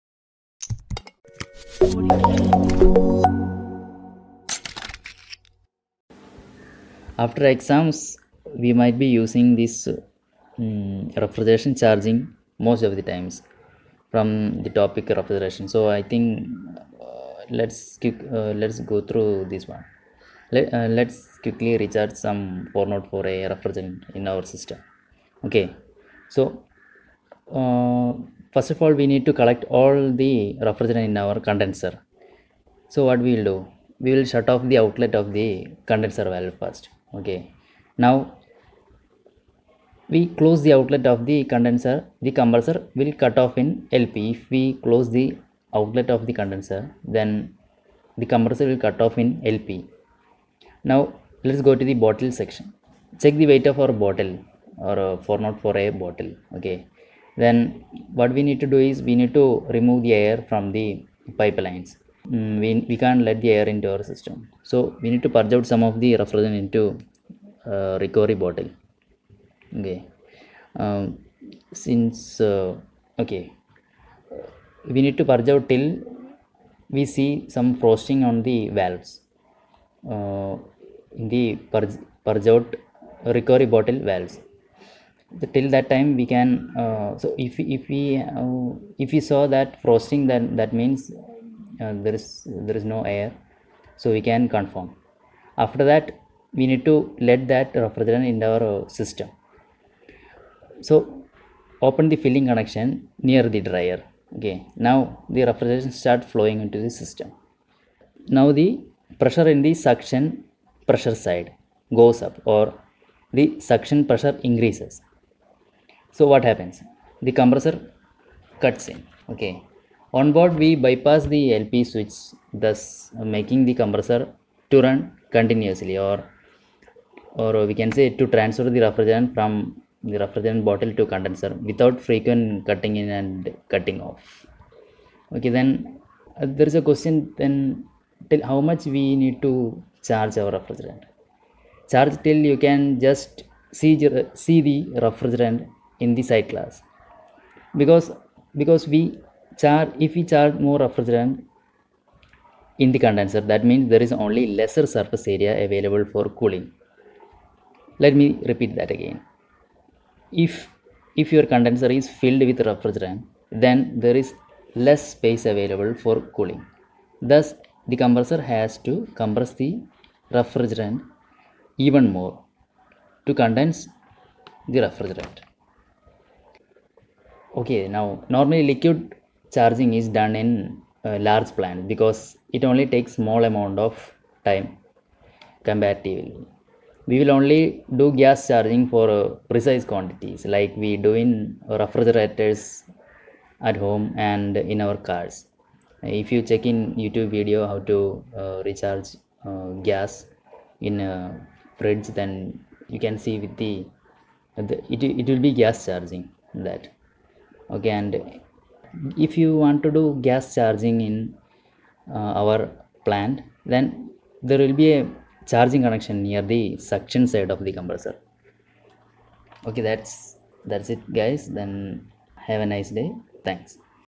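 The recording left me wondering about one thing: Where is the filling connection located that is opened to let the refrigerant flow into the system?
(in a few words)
Near the dryer.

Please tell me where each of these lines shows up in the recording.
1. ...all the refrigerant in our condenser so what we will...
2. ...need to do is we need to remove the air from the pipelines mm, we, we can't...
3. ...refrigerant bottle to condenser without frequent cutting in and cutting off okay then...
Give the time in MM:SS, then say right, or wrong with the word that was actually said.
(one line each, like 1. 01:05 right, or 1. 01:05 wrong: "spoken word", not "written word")
1. 00:29 right
2. 00:58 right
3. 02:10 right.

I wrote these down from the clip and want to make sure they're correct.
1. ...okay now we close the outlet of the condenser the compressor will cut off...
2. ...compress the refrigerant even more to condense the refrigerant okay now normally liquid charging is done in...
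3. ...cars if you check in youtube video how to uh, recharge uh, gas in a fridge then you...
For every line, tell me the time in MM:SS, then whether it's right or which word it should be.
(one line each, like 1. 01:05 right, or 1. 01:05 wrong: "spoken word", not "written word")
1. 00:37 right
2. 02:49 right
3. 03:15 right.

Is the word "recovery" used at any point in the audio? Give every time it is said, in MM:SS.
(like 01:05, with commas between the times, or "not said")
01:08, 01:23.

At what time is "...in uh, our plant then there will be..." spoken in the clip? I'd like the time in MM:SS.
03:31.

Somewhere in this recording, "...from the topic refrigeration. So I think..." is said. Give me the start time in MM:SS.
00:14.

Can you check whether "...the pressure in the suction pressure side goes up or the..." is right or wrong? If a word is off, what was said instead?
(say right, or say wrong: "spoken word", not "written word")
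right.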